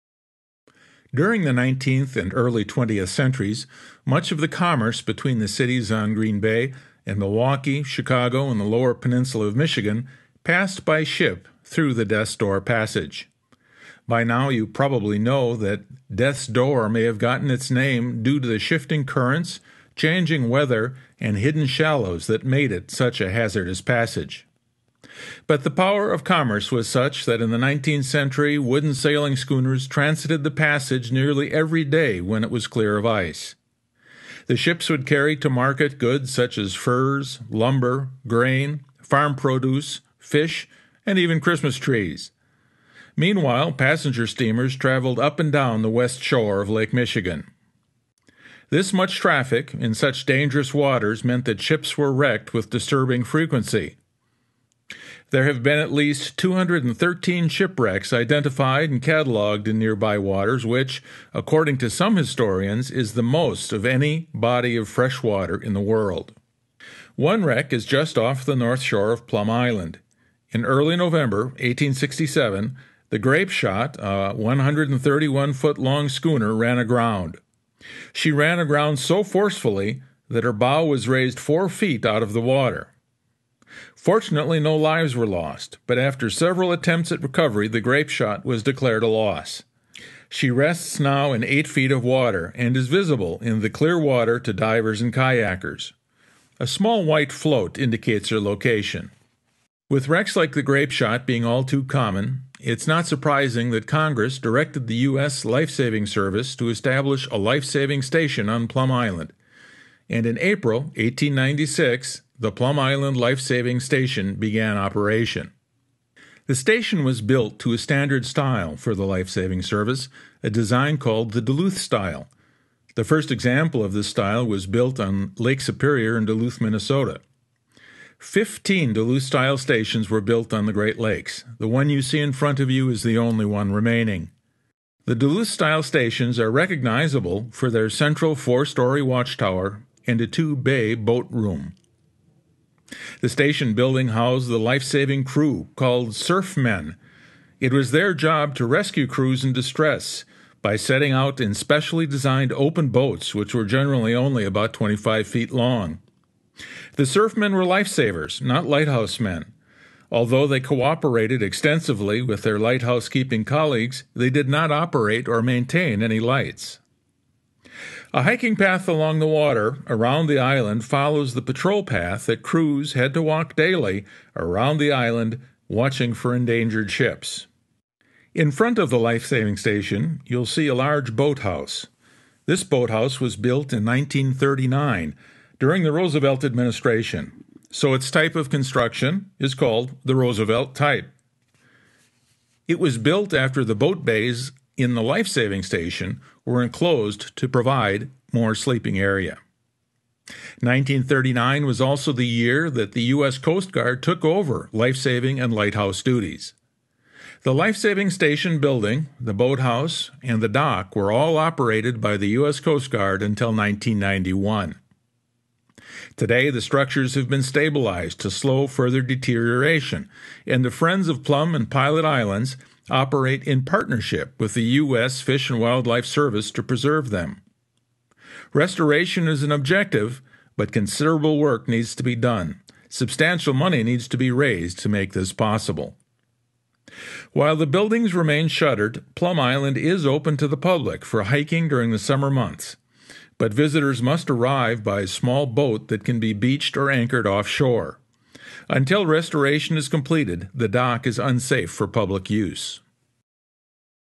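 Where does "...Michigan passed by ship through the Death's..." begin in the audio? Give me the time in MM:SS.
00:09.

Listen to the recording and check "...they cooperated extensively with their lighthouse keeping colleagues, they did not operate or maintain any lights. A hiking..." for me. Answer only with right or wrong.
right.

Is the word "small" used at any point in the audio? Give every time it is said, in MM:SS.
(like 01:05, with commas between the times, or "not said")
01:36, 04:05.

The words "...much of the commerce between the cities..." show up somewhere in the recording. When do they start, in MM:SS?
00:04.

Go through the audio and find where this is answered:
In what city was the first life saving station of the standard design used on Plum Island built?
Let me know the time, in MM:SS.
02:06.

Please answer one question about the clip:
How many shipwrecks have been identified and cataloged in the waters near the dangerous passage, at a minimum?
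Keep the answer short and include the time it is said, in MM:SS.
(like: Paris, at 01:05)
213, at 00:56.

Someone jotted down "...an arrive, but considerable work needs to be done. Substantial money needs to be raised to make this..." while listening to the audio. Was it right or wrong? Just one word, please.
wrong.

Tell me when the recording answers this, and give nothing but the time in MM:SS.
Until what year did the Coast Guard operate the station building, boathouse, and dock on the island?
03:33.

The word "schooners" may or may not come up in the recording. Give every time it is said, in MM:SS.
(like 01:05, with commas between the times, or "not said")
00:29, 01:16.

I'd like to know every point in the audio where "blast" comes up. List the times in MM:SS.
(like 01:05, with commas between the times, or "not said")
not said.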